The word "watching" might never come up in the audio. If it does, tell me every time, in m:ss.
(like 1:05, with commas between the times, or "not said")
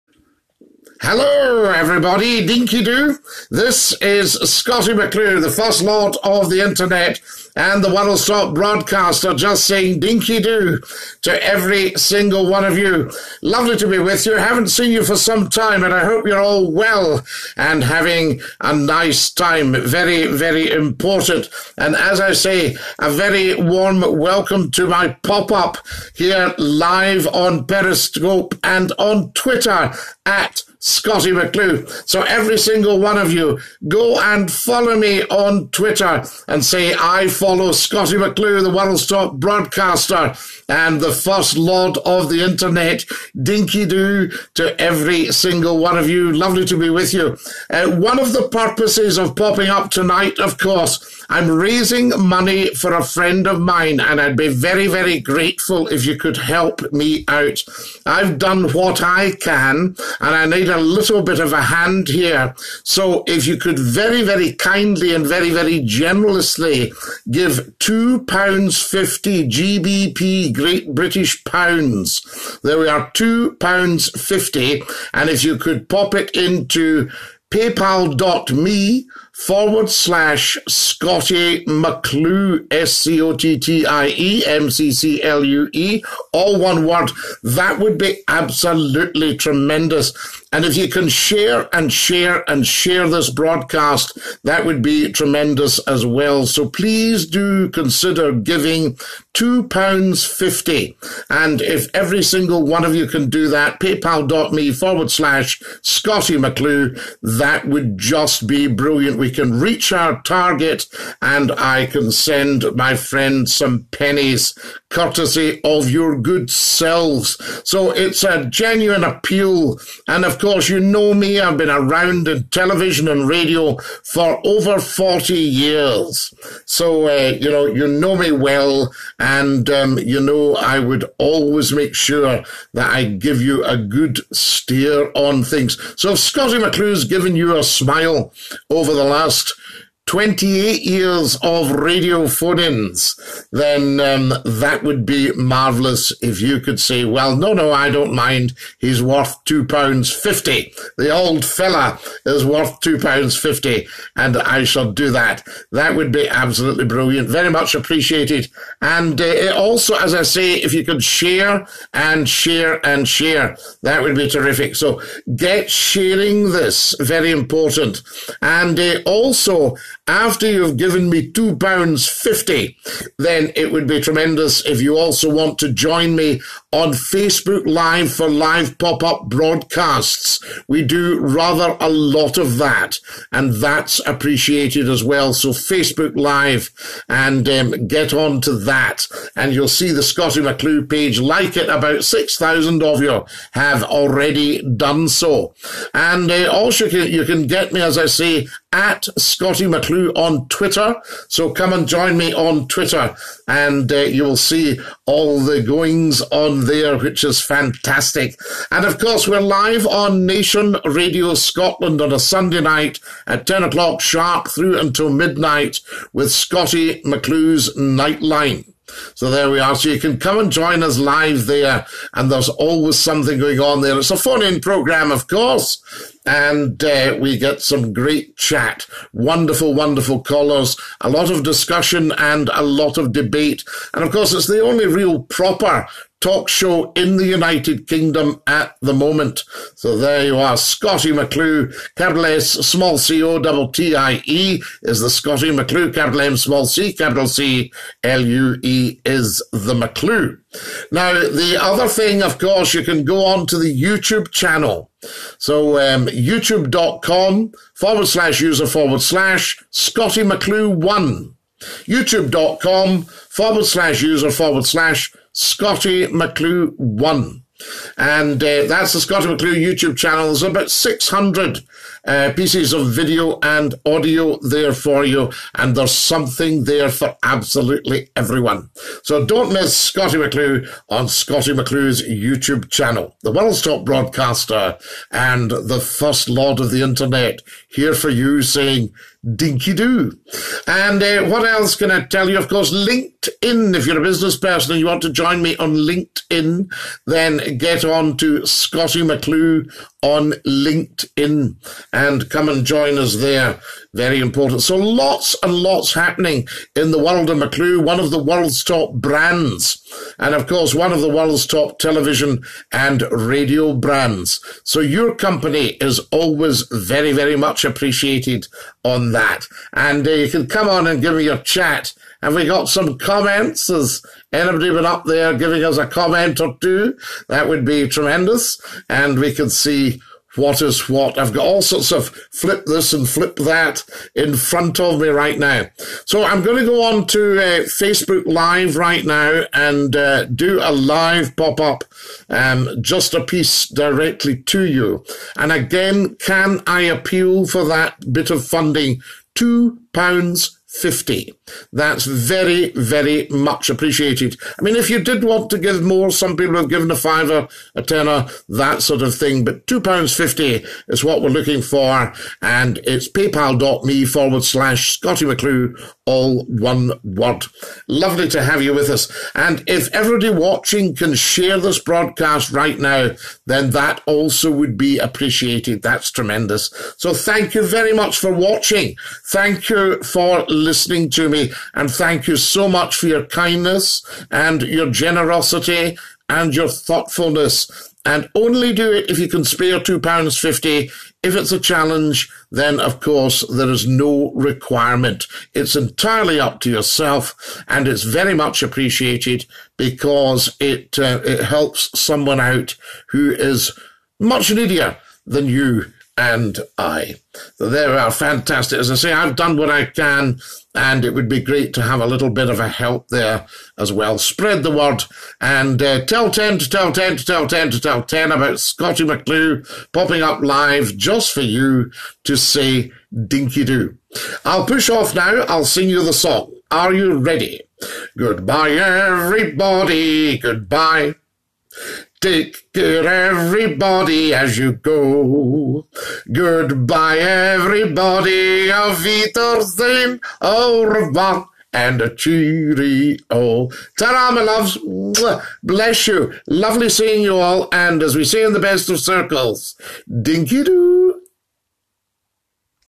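6:10, 6:18.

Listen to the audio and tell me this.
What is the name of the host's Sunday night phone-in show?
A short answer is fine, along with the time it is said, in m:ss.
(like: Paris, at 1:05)
Scottie McClue's Nightline, at 3:36.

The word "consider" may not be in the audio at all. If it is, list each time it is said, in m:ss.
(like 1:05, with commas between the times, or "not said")
1:37.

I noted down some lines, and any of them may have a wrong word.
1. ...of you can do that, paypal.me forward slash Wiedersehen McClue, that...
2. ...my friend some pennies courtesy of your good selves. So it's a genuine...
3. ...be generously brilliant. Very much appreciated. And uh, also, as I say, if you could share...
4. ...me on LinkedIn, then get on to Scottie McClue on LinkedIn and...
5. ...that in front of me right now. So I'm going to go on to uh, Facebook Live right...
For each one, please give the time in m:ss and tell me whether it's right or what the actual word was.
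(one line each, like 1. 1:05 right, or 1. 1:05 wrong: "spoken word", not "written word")
1. 1:42 wrong: "Scottie", not "Wiedersehen"
2. 1:52 right
3. 2:36 wrong: "absolutely", not "generously"
4. 4:55 right
5. 5:33 right.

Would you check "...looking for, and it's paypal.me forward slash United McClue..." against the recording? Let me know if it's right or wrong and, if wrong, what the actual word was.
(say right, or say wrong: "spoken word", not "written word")
wrong: "Scottie", not "United".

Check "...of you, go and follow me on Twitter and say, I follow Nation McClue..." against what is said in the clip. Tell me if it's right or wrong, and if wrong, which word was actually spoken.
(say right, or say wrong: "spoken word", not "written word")
wrong: "Scottie", not "Nation".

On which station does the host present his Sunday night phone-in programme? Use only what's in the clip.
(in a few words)
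Nation Radio Scotland.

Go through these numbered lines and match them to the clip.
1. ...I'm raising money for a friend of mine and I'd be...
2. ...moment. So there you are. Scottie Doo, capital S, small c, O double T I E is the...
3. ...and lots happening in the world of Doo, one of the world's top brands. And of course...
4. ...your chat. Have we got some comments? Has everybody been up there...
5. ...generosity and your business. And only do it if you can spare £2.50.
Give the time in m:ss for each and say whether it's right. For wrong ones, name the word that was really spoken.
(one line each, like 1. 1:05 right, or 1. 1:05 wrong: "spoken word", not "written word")
1. 0:51 right
2. 3:58 wrong: "McClue", not "Doo"
3. 5:05 wrong: "McClue", not "Doo"
4. 5:21 wrong: "anybody", not "everybody"
5. 6:24 wrong: "thoughtfulness", not "business".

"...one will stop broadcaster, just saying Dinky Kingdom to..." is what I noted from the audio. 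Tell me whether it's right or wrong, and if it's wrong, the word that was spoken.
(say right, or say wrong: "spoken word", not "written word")
wrong: "Doo", not "Kingdom".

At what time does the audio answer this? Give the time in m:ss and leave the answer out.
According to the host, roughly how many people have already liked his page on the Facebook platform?
3:11.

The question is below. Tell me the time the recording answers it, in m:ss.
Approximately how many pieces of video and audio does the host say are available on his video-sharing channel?
4:30.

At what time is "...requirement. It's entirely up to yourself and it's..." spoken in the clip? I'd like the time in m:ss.
6:34.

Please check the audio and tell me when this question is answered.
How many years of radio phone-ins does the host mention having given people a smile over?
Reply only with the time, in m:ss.
2:20.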